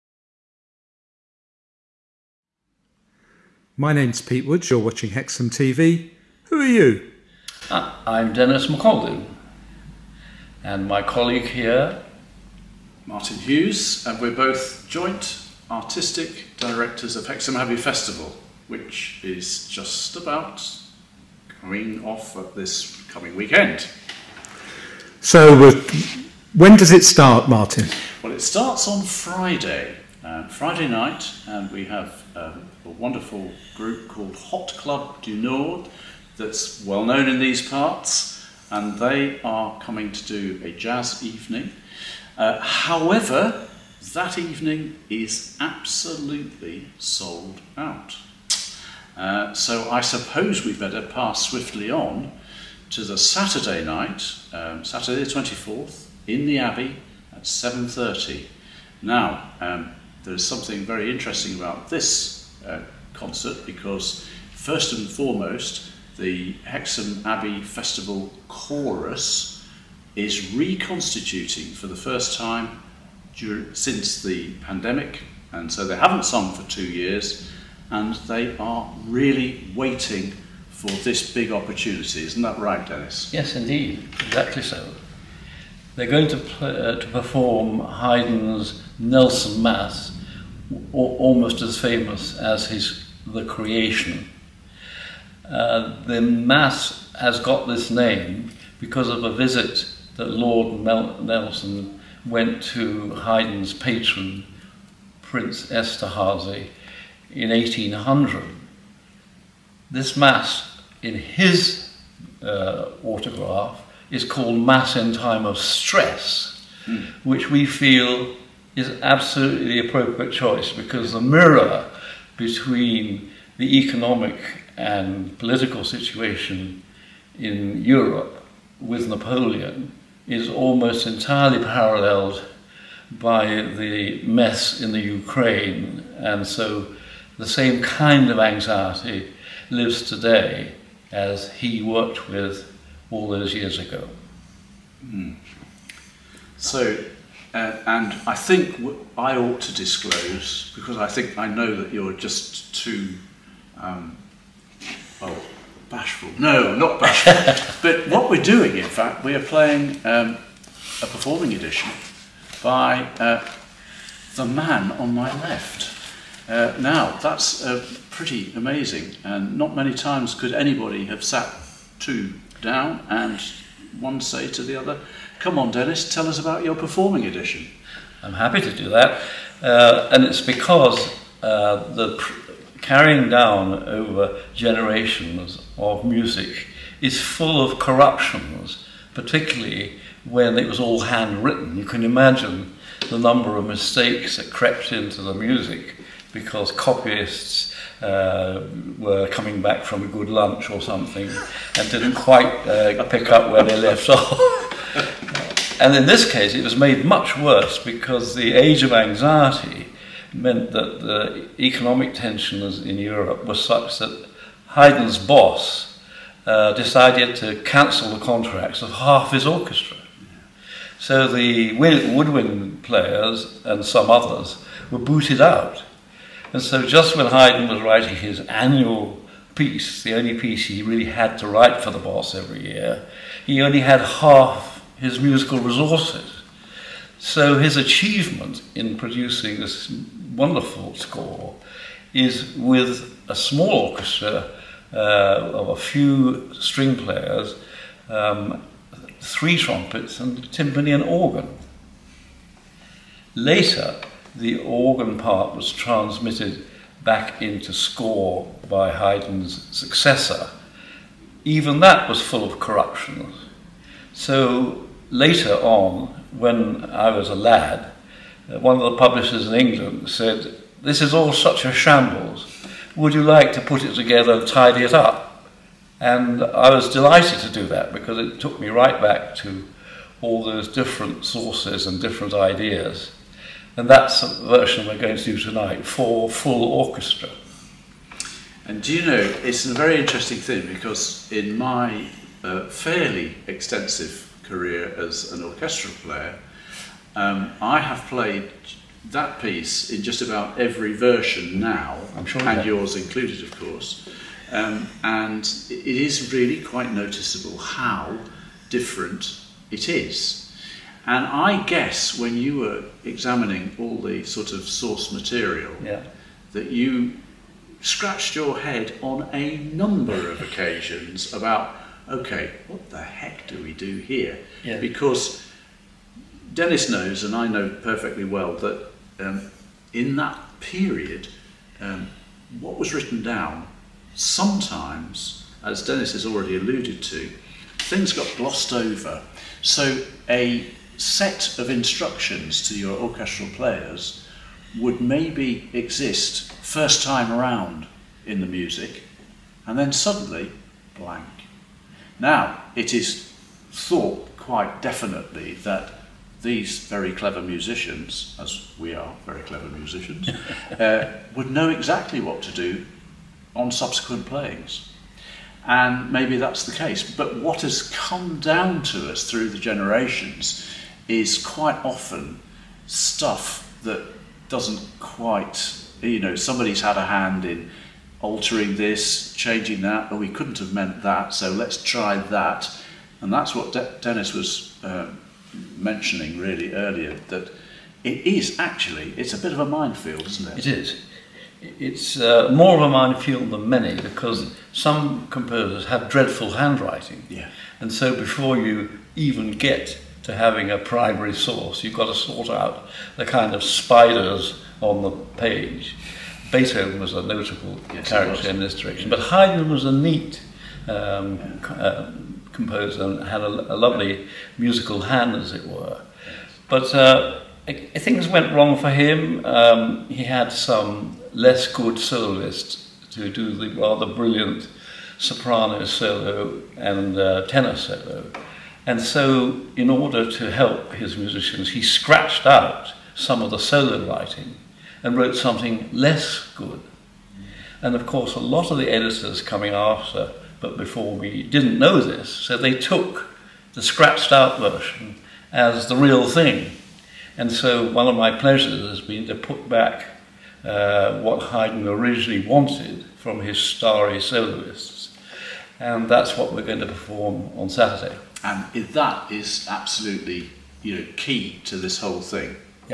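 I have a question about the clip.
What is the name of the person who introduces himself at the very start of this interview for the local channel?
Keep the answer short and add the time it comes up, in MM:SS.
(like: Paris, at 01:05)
Pete Woods, at 00:04.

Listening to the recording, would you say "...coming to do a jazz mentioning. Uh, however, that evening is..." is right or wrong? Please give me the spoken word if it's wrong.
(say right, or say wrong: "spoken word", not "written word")
wrong: "evening", not "mentioning".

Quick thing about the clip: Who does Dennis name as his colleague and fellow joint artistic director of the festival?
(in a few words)
Martin Hughes.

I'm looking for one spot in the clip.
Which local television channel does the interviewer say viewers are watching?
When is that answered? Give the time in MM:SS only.
00:05.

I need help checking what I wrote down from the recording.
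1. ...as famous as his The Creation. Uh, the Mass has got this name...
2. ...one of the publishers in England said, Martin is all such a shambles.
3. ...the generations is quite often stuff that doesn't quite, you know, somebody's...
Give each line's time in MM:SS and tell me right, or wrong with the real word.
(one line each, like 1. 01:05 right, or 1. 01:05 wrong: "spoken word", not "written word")
1. 01:31 right
2. 04:28 wrong: "This", not "Martin"
3. 06:09 right.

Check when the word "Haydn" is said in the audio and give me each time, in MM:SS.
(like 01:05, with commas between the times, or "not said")
01:27, 01:43, 03:34, 03:47, 04:18, 06:49, 07:31.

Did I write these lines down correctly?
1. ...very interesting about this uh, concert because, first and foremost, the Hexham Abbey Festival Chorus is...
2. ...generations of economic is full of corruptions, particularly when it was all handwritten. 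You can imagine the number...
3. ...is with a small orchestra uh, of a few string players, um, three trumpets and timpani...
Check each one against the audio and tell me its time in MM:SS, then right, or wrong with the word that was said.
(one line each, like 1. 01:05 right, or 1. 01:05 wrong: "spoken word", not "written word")
1. 01:00 right
2. 03:04 wrong: "music", not "economic"
3. 04:02 right.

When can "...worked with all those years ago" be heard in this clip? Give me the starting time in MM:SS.
02:21.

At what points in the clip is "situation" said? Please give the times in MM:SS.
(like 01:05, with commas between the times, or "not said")
02:05.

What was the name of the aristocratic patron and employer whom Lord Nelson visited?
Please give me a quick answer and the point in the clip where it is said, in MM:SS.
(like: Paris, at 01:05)
Prince Esterhazy, at 01:45.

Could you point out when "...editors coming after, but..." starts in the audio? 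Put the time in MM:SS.
07:18.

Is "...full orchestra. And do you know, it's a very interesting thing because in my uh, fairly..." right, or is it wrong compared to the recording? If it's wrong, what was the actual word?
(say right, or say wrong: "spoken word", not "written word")
right.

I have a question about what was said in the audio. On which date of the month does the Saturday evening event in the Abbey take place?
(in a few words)
24th.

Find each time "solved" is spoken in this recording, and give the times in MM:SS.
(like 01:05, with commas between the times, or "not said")
not said.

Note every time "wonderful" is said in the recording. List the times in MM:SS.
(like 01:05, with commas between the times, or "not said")
00:32, 04:00.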